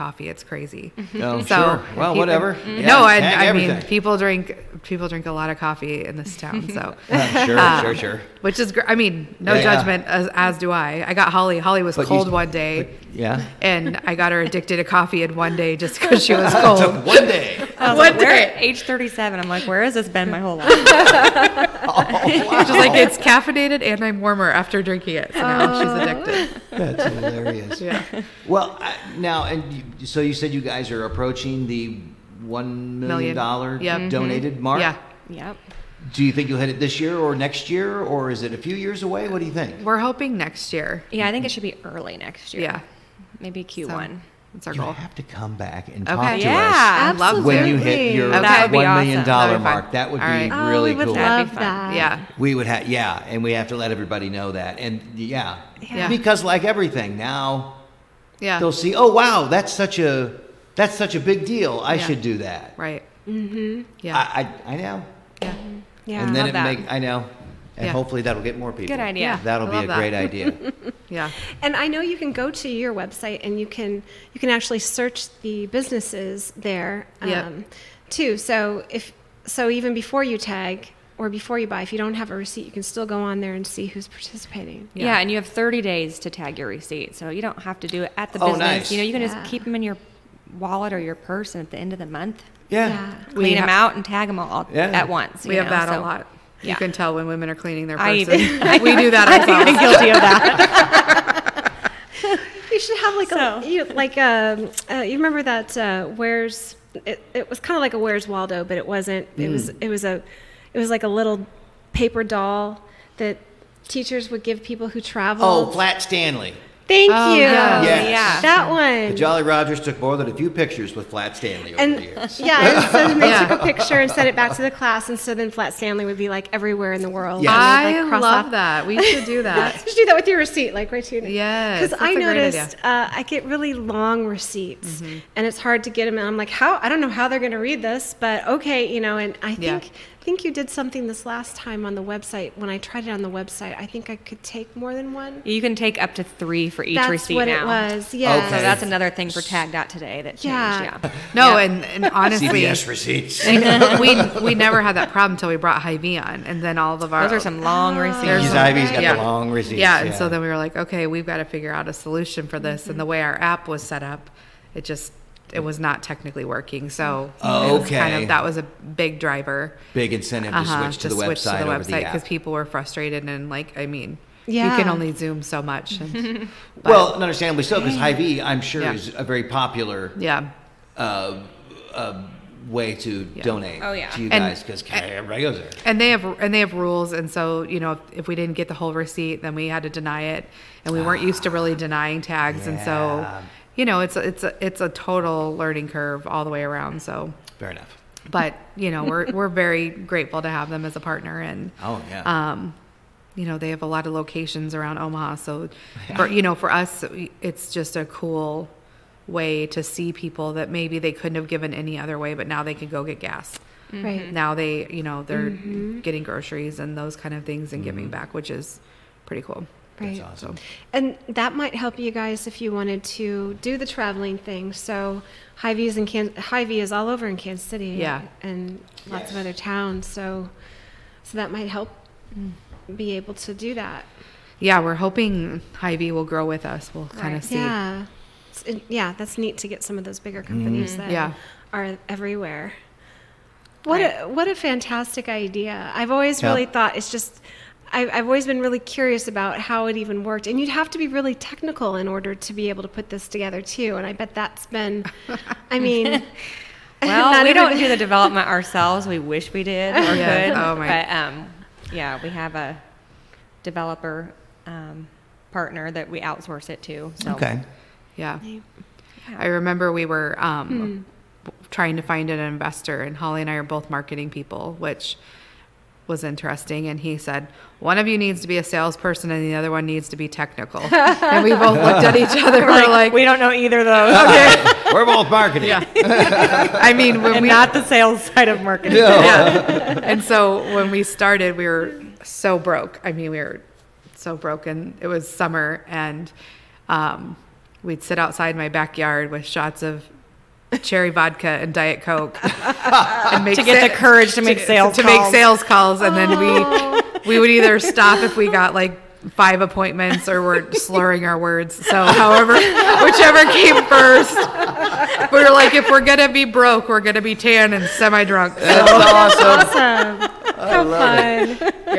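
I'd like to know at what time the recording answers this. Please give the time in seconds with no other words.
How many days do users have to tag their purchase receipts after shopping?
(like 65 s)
85 s.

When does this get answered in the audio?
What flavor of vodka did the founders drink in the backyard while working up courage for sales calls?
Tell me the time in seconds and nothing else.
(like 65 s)
300 s.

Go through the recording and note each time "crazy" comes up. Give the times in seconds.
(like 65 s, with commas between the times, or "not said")
0 s.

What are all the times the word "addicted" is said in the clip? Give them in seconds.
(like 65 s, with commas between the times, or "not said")
14 s, 26 s.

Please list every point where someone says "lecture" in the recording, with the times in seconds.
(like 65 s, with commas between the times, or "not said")
not said.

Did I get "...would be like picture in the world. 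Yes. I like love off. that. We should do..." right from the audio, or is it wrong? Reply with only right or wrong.
wrong.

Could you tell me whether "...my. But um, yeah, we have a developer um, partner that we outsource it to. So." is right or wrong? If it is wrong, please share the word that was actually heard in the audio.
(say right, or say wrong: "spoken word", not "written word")
right.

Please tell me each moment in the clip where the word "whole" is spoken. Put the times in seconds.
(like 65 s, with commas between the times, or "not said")
20 s, 188 s.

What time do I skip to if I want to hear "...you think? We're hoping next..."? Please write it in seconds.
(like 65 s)
39 s.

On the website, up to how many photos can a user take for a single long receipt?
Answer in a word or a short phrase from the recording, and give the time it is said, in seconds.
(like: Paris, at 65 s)
3, at 146 s.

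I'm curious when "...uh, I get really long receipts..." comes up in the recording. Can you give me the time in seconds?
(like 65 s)
132 s.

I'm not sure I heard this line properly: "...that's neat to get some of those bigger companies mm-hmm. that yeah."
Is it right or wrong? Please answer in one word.
right.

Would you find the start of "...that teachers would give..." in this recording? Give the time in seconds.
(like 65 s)
113 s.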